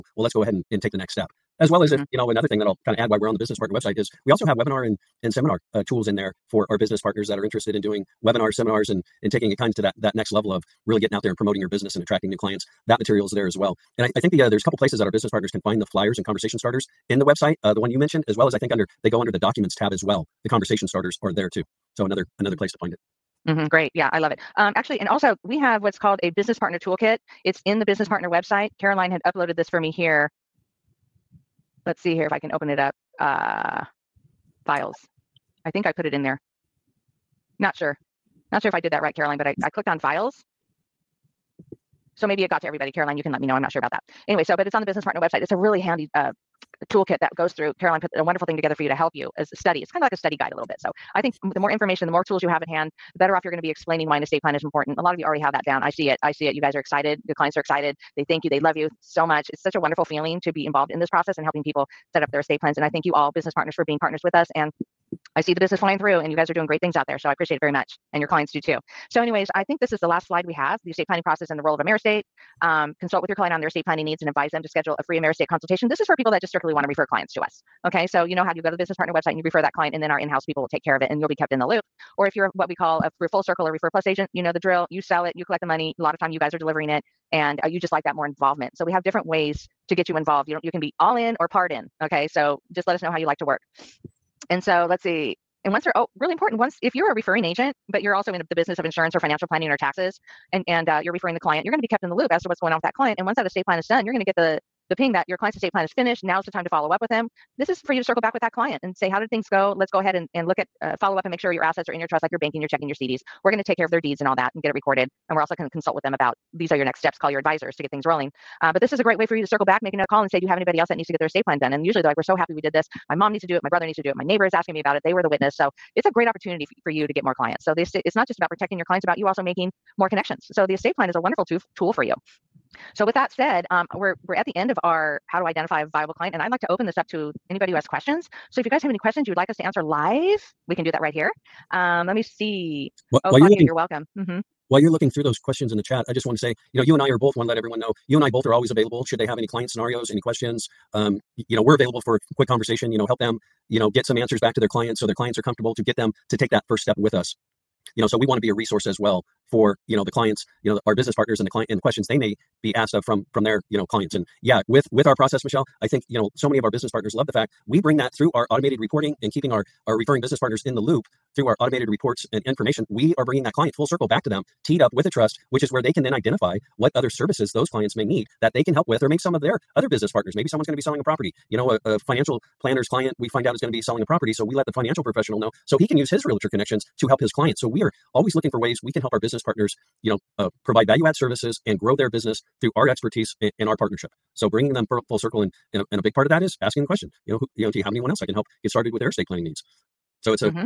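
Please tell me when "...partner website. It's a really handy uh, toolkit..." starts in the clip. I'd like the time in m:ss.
0:45.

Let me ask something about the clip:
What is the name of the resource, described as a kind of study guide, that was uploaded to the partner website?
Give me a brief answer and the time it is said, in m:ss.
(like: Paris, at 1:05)
Business partner toolkit, at 0:26.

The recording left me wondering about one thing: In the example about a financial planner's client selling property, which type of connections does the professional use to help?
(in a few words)
Realtor connections.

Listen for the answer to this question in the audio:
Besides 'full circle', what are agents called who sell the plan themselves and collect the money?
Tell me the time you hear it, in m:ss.
1:23.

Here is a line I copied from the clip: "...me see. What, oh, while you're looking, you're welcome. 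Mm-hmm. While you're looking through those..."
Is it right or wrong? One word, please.
right.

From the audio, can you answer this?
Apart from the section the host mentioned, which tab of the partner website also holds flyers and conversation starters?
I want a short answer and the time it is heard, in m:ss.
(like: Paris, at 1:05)
Documents tab, at 0:19.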